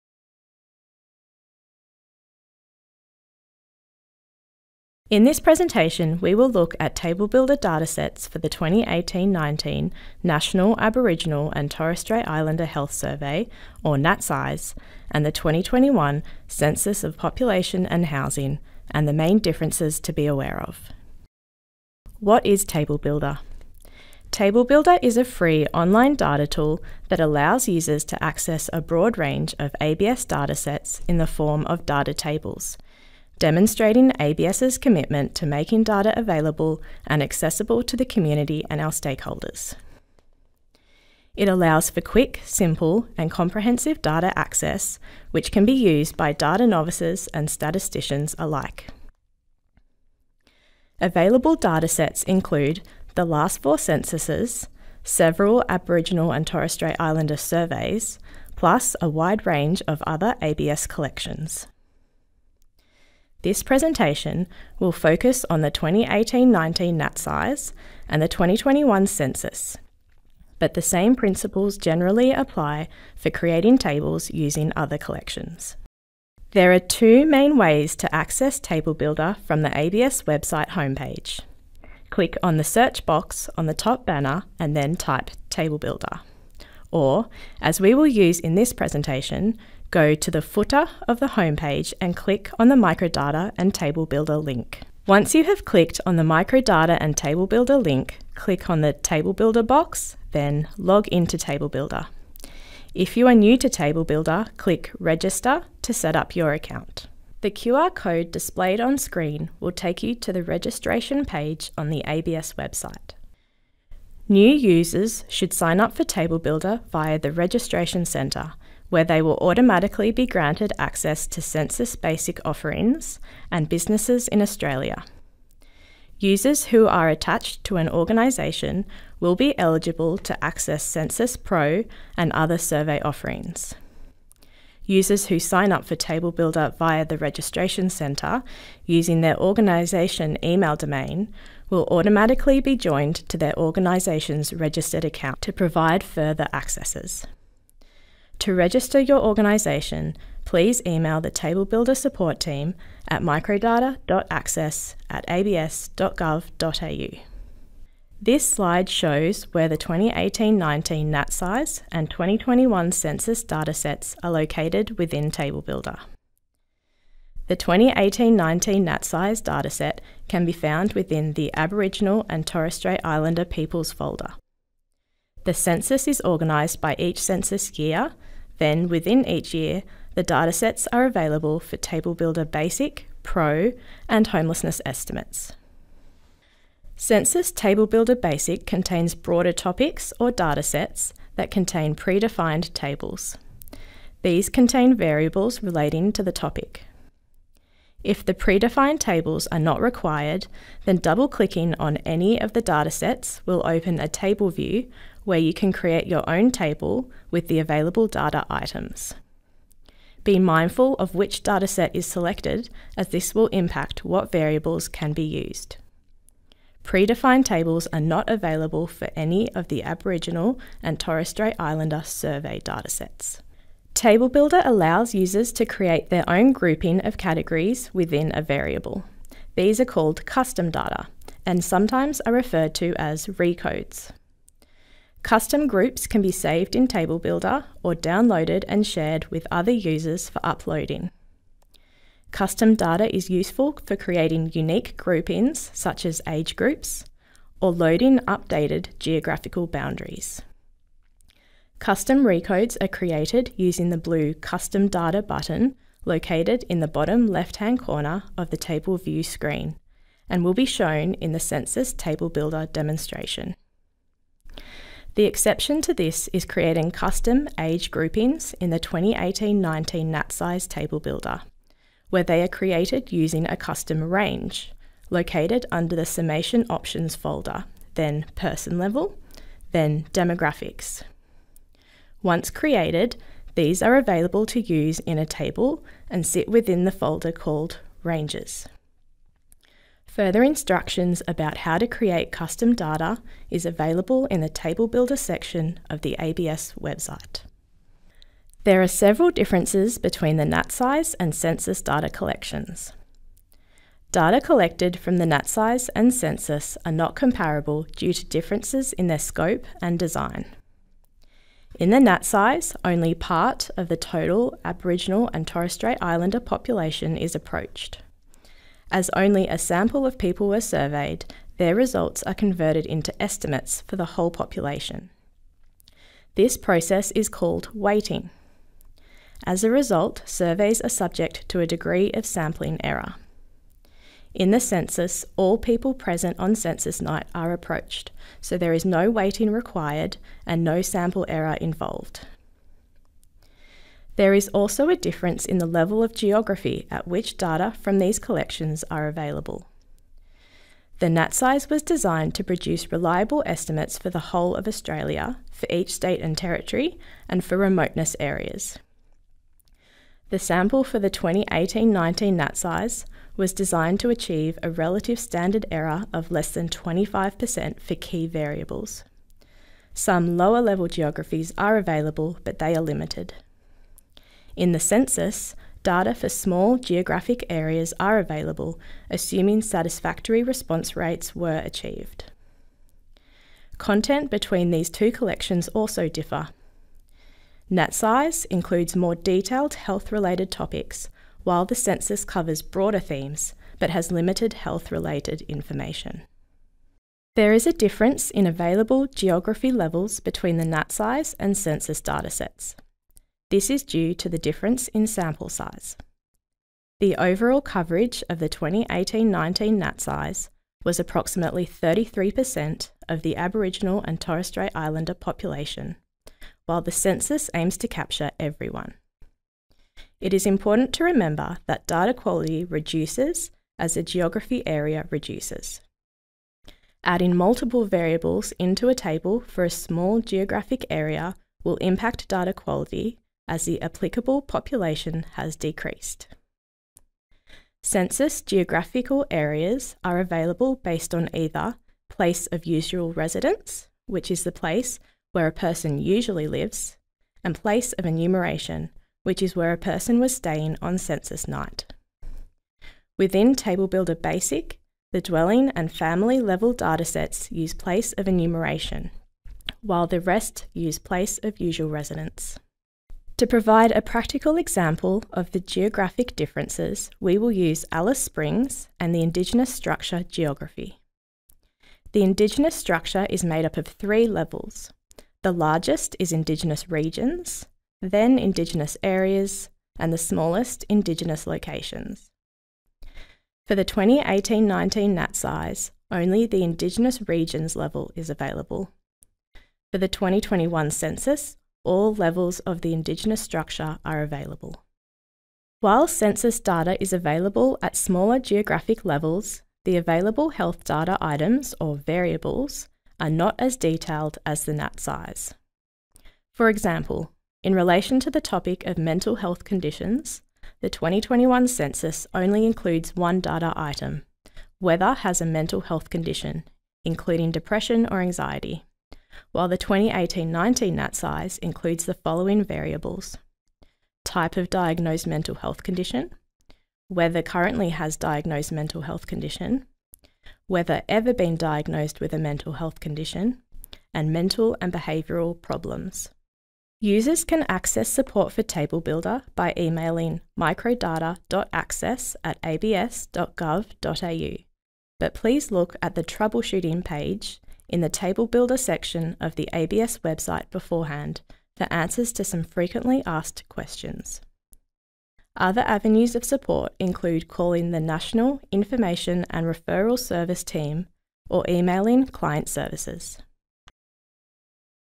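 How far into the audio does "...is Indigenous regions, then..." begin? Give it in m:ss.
7:56.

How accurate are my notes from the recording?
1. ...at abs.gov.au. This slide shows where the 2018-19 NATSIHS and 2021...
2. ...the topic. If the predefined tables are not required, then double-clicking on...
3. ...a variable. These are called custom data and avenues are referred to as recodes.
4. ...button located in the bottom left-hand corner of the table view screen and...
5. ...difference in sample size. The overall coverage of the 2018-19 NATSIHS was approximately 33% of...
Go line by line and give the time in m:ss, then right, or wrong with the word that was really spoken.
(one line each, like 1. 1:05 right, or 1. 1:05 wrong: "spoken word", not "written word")
1. 2:35 right
2. 3:16 right
3. 3:48 wrong: "sometimes", not "avenues"
4. 4:15 right
5. 6:44 right.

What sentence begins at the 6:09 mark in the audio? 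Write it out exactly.
Some lower level geographies are available, but they are limited.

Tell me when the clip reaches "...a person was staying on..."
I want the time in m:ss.
7:29.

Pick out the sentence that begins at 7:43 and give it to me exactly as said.
To provide a practical example of the geographic differences, we will use Alice Springs and the Indigenous Structure geography.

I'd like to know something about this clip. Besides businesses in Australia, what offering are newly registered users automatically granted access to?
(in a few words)
Census Basic.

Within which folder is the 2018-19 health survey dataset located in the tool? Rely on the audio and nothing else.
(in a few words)
Aboriginal and Torres Strait Islander Peoples.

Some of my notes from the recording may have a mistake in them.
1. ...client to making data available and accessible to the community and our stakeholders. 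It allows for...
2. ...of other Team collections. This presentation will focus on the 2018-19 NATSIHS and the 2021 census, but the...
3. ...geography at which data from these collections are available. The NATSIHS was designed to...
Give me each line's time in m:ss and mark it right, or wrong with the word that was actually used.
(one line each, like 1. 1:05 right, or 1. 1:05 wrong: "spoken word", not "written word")
1. 0:34 wrong: "commitment", not "client"
2. 0:59 wrong: "ABS", not "Team"
3. 5:46 right.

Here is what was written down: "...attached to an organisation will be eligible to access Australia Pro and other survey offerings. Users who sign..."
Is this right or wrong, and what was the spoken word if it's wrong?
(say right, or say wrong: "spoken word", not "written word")
wrong: "Census", not "Australia".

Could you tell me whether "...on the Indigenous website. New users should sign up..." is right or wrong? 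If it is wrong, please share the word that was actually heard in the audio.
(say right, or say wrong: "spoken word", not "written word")
wrong: "ABS", not "Indigenous".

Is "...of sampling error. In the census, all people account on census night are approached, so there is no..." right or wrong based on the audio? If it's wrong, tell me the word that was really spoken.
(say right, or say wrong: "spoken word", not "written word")
wrong: "present", not "account".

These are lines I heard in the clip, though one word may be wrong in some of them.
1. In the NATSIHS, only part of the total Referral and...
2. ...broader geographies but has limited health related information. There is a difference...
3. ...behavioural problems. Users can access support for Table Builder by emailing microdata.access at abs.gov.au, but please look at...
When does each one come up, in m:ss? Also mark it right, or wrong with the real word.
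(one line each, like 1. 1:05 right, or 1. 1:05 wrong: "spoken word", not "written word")
1. 5:11 wrong: "Aboriginal", not "Referral"
2. 6:32 wrong: "themes", not "geographies"
3. 8:54 right.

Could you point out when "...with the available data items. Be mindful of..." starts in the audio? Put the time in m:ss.
3:27.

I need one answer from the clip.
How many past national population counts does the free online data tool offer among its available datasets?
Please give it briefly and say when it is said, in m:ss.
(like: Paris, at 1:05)
4, at 0:53.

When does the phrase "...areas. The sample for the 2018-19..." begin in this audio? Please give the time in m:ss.
5:58.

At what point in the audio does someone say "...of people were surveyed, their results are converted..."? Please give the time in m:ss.
5:20.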